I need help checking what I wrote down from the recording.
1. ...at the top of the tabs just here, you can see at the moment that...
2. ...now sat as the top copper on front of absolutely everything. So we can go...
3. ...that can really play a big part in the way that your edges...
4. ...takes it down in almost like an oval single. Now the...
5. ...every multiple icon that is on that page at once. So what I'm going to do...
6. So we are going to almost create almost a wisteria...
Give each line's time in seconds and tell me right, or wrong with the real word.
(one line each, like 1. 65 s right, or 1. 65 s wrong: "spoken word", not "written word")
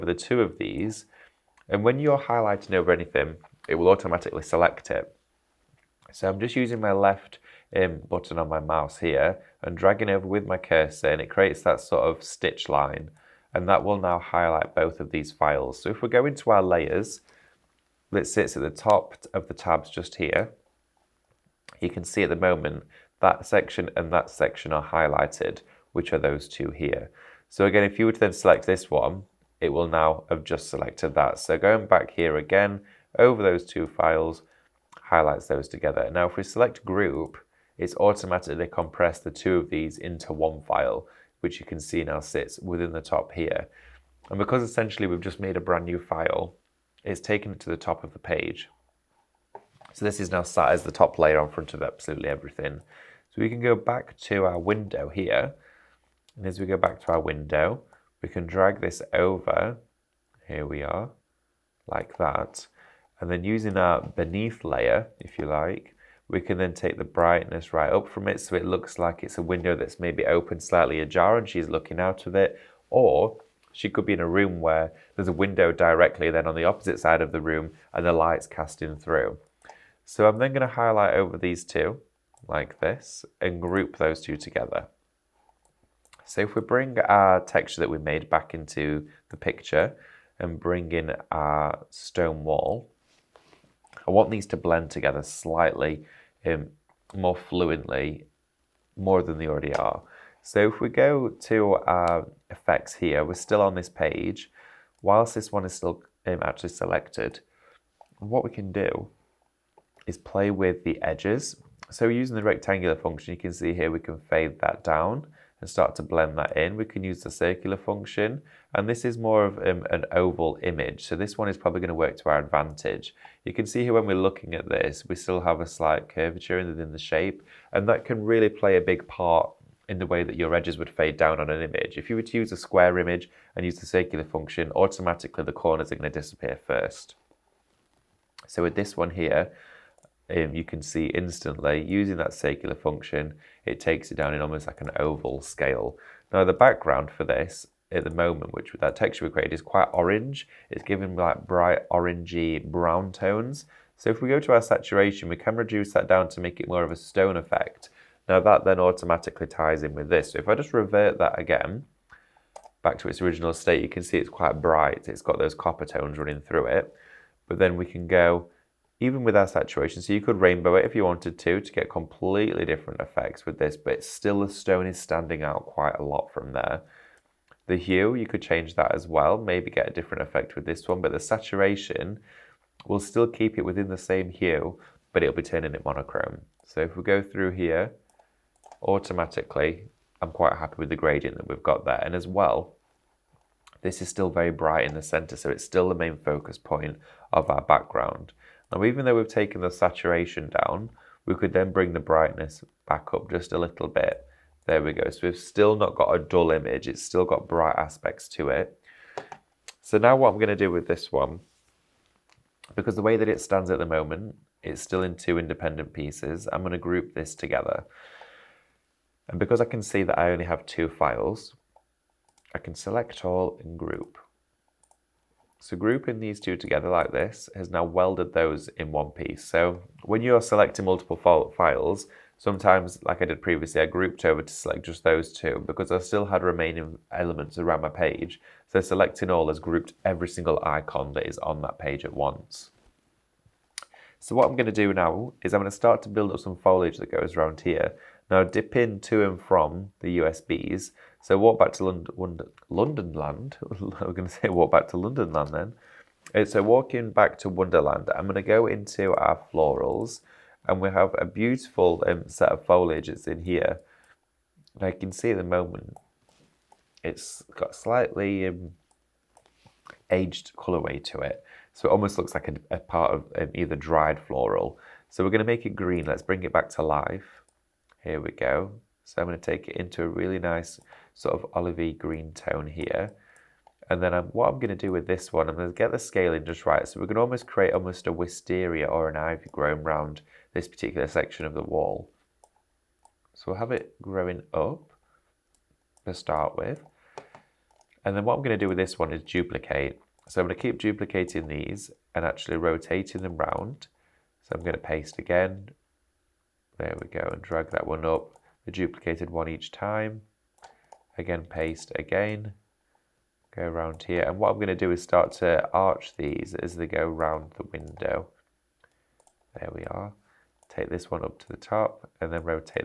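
1. 18 s right
2. 50 s wrong: "layer", not "copper"
3. 127 s right
4. 143 s wrong: "scale", not "single"
5. 240 s wrong: "single", not "multiple"
6. 286 s right.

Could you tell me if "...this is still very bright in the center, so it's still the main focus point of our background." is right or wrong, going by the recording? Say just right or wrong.
right.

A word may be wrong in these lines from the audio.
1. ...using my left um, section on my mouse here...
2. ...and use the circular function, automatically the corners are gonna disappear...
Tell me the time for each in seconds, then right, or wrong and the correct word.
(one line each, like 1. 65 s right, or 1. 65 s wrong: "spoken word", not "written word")
1. 6 s wrong: "button", not "section"
2. 133 s right.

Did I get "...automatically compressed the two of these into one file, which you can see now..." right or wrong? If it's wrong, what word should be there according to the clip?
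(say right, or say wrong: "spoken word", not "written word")
right.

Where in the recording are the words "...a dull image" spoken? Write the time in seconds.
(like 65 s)
206 s.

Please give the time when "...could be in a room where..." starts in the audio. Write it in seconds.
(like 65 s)
73 s.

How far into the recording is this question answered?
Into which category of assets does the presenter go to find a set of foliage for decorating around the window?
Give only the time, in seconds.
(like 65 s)
259 s.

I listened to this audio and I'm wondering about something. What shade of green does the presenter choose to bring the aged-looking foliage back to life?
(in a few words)
Olivey green.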